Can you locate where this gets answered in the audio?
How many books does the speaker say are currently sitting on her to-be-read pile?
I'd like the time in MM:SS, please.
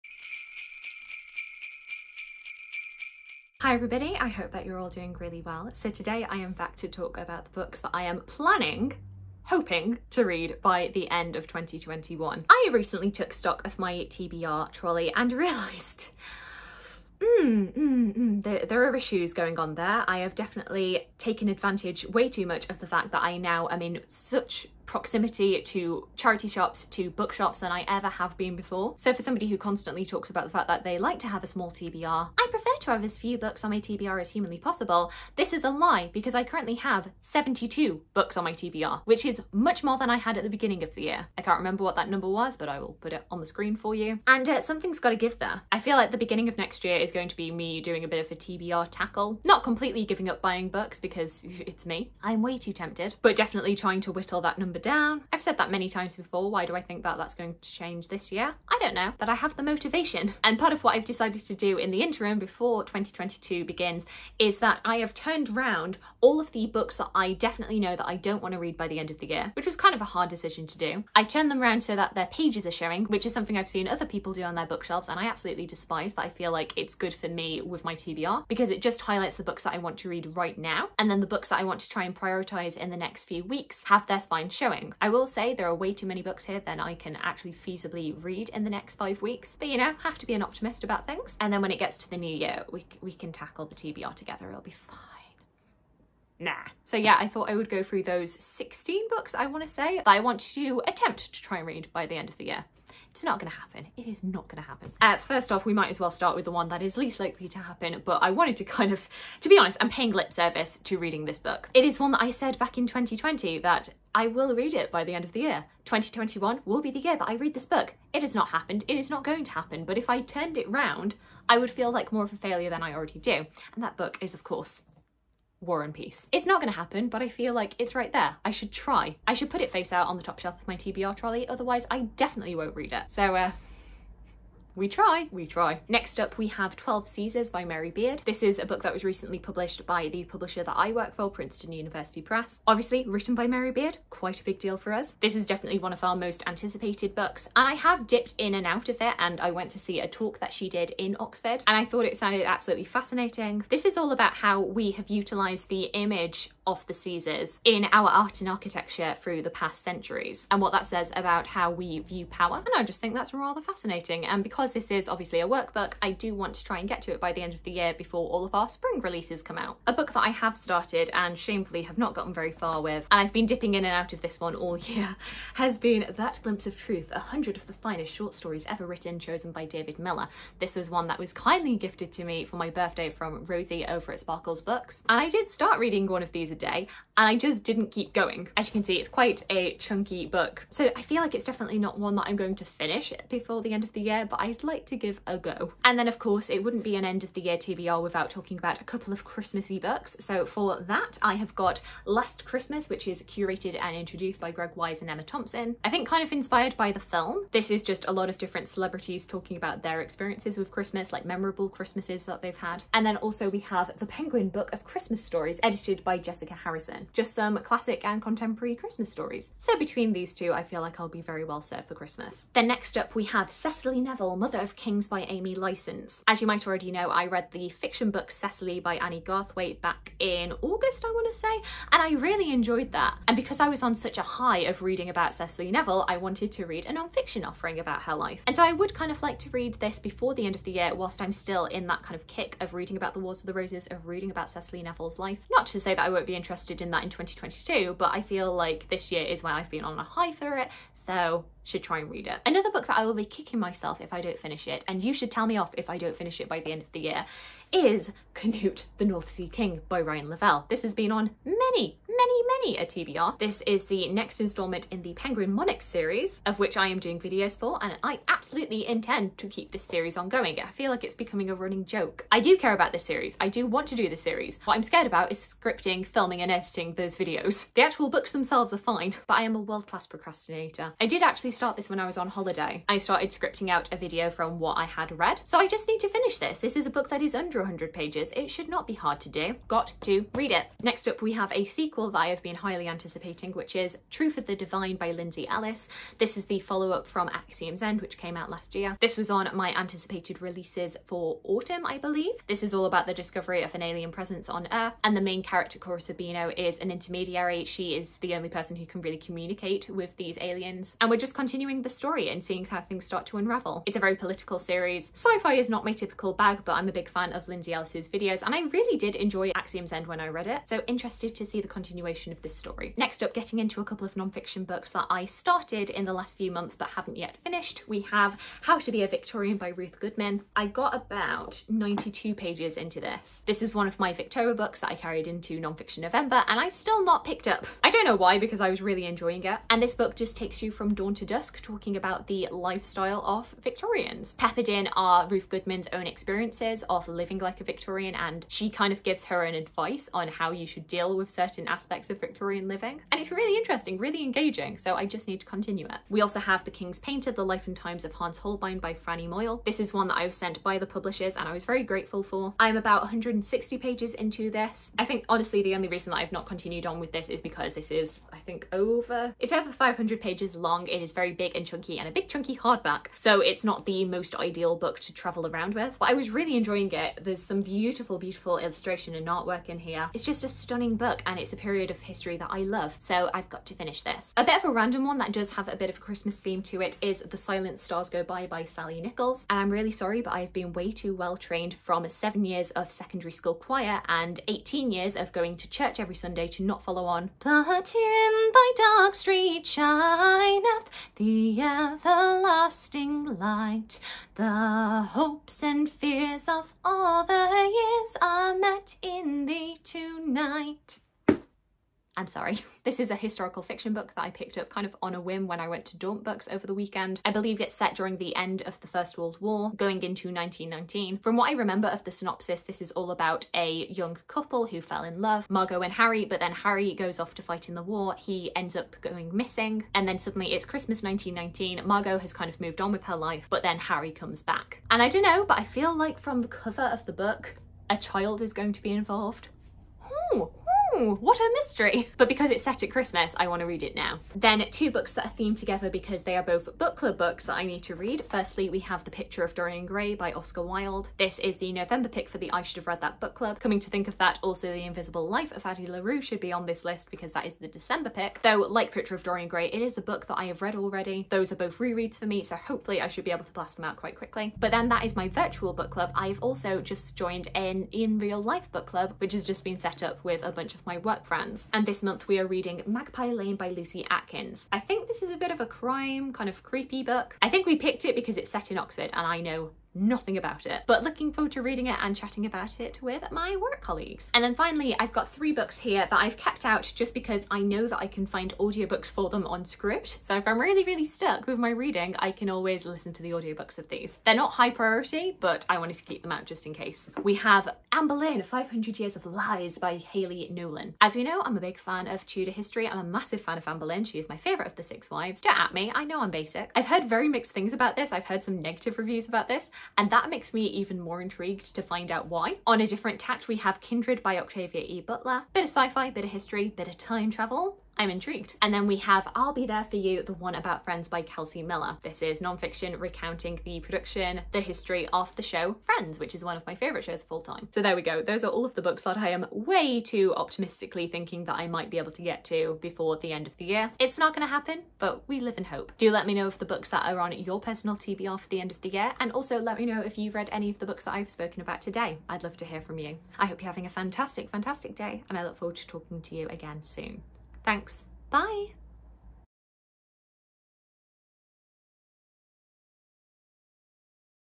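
00:37.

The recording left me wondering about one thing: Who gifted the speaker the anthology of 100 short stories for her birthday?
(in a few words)
Rosie.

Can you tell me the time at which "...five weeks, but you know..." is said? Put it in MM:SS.
01:28.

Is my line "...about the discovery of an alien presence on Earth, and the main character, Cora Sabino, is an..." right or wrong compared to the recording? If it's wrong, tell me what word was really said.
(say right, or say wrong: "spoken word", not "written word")
right.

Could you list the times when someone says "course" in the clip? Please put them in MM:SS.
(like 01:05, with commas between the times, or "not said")
02:04, 03:16.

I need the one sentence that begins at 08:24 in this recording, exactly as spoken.
She is my favorite of the six wives.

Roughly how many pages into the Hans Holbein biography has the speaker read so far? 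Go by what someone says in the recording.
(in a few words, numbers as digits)
160.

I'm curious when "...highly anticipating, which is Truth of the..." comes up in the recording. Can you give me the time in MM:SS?
04:52.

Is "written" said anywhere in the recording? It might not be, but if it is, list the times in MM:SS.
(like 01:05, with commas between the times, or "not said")
02:23, 02:58.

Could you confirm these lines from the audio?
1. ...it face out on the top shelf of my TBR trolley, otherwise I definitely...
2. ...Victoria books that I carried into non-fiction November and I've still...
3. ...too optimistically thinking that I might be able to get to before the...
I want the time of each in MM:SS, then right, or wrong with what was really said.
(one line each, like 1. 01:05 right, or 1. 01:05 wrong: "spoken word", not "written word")
1. 02:09 right
2. 05:34 right
3. 08:50 right.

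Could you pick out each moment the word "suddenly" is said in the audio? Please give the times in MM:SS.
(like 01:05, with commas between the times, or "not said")
07:10.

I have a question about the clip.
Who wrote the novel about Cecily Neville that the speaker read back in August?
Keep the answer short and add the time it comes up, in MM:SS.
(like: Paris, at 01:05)
Annie Garthwaite, at 03:48.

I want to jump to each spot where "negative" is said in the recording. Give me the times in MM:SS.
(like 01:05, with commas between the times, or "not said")
08:28.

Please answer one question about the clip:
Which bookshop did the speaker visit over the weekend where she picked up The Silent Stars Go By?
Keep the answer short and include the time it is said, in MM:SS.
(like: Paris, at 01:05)
Daunt Books, at 06:55.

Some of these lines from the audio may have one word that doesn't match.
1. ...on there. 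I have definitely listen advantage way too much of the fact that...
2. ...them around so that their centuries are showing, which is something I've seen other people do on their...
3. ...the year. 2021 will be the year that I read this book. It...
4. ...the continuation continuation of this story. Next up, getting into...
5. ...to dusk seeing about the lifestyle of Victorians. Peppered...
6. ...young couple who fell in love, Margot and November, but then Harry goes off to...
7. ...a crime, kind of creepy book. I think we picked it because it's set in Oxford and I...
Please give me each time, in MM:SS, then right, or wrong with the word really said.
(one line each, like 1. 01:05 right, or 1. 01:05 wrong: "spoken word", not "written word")
1. 00:19 wrong: "taken", not "listen"
2. 01:11 wrong: "pages", not "centuries"
3. 01:55 right
4. 05:21 right
5. 05:41 wrong: "talking", not "seeing"
6. 07:03 wrong: "Harry", not "November"
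7. 07:55 right.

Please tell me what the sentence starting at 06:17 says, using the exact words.
There's some beautiful, beautiful illustration and artwork in here.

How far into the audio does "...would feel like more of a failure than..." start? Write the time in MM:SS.
02:01.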